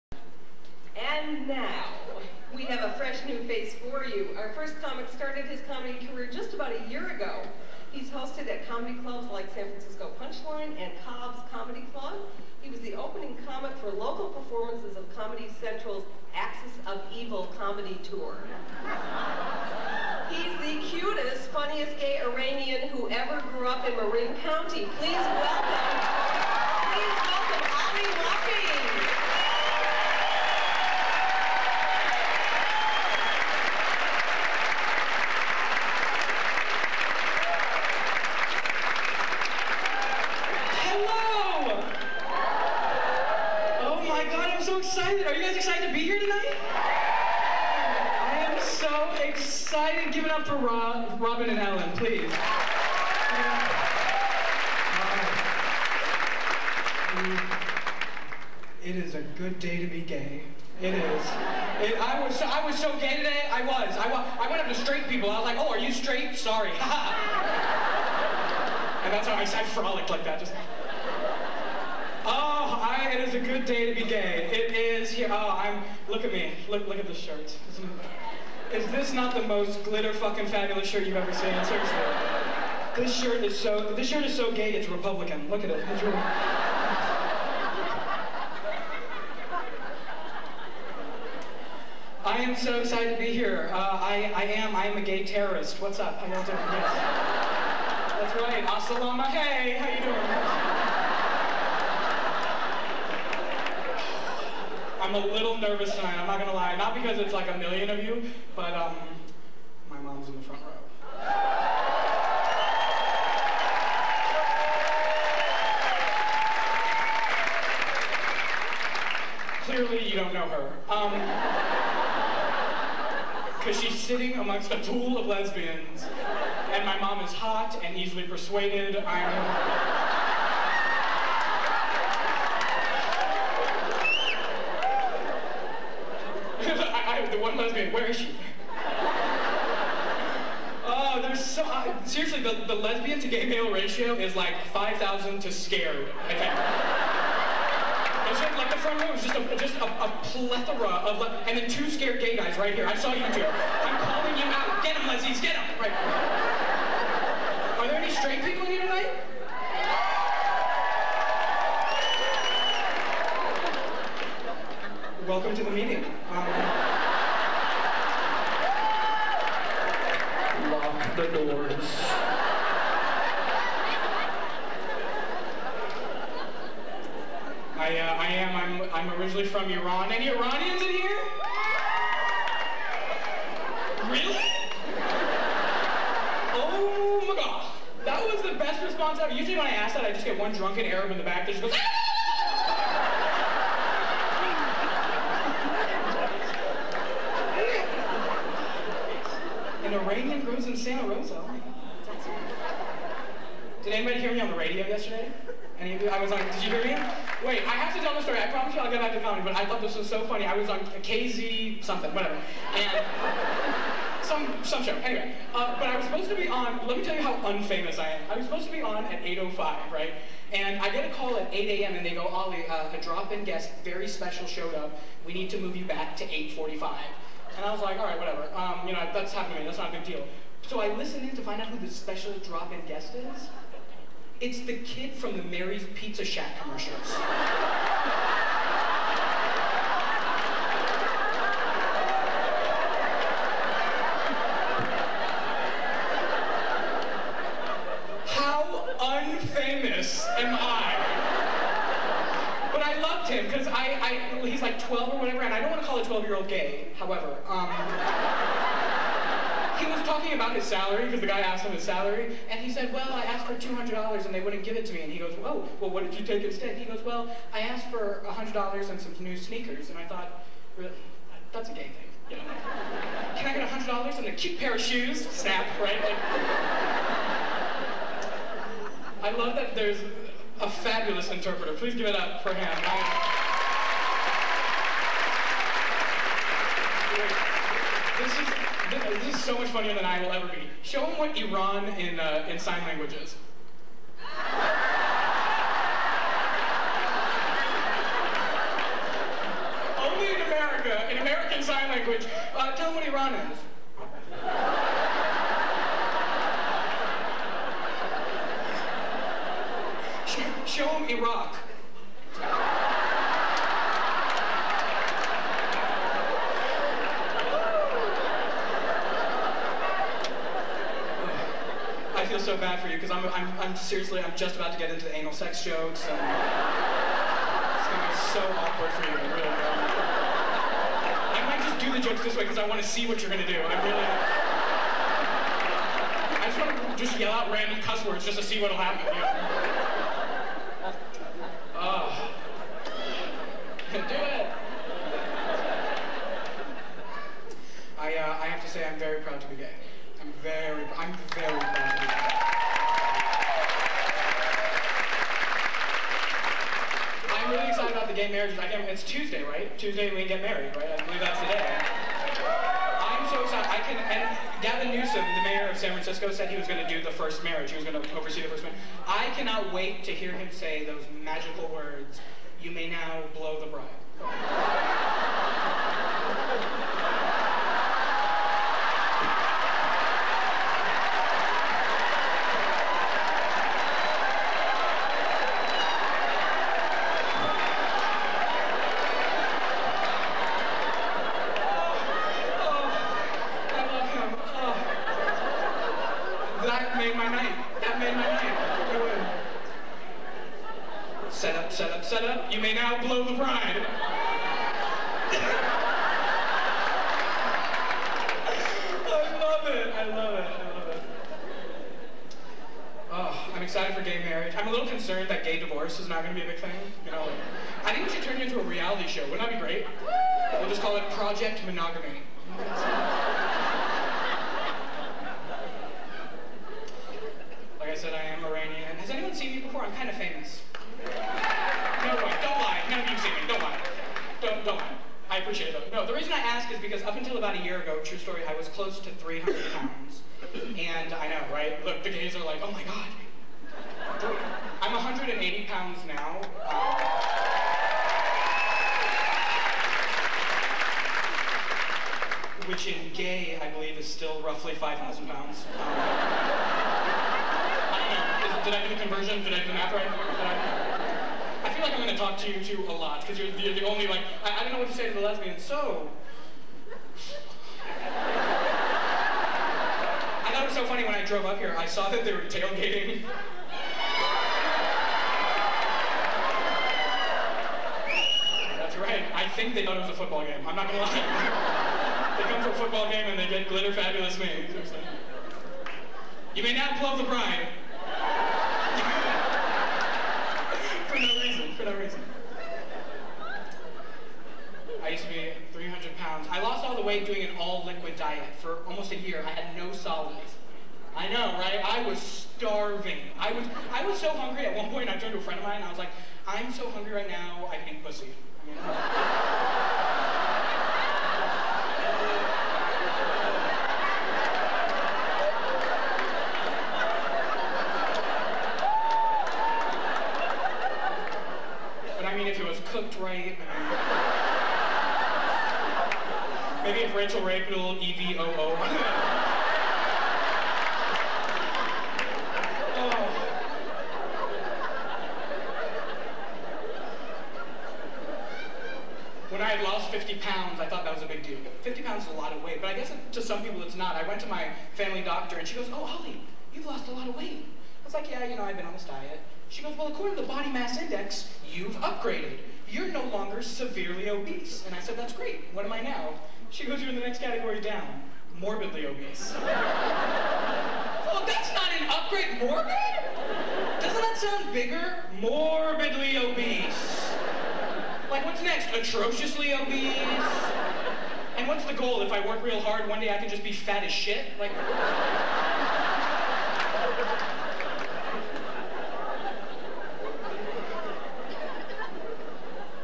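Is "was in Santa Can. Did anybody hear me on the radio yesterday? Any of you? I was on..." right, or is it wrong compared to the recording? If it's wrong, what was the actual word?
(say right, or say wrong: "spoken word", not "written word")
wrong: "Rosa", not "Can".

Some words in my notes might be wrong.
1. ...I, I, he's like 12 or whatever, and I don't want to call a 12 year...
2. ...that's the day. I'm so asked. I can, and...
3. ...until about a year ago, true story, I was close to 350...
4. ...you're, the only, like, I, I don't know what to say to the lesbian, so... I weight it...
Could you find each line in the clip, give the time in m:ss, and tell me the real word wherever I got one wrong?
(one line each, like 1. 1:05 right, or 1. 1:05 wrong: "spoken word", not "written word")
1. 4:13 right
2. 6:01 wrong: "excited", not "asked"
3. 7:17 wrong: "300", not "350"
4. 7:43 wrong: "thought", not "weight".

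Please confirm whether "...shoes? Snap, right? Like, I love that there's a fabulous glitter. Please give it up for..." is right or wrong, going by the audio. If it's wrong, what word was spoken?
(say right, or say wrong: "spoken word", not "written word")
wrong: "interpreter", not "glitter".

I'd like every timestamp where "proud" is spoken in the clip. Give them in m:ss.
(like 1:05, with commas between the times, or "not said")
5:49.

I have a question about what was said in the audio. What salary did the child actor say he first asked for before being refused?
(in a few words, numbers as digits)
$200.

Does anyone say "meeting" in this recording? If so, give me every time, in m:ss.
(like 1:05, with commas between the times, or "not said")
2:45.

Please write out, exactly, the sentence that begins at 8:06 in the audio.
You may not blow the bride, for no reason.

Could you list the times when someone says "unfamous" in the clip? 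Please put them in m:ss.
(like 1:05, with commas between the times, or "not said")
3:37, 4:09.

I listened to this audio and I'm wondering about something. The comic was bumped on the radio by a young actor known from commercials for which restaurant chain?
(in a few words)
Mary's Pizza Shack.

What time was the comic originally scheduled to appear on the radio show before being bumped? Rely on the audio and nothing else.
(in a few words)
8:05.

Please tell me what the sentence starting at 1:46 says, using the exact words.
Not because it's like a million of you, but um, my mom's in the front row.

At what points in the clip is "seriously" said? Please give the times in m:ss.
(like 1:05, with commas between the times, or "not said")
1:21, 2:22, 5:23.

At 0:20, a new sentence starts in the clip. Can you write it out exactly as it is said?
He's the cutest, funniest gay Iranian who ever grew up in Marin County.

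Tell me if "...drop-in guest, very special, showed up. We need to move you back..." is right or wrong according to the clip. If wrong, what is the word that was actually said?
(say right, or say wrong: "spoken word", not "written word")
right.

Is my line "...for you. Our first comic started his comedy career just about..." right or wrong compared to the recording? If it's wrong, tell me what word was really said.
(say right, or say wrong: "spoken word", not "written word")
right.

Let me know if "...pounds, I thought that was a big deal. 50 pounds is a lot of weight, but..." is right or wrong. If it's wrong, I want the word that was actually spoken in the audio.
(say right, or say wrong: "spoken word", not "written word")
right.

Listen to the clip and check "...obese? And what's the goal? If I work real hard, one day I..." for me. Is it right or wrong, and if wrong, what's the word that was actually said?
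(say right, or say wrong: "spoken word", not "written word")
right.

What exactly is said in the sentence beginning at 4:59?
Only in America, in American Sign Language, uh, tell them what Iran is.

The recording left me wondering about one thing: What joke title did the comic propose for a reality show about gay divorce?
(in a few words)
Project Monogamy.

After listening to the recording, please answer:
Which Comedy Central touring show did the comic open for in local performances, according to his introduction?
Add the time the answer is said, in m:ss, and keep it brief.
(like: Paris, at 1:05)
Axis of Evil, at 0:16.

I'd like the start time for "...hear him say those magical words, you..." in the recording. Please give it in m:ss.
6:10.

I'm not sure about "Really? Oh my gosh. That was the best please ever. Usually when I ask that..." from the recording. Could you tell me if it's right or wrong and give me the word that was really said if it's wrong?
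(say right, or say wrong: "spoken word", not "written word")
wrong: "response", not "please".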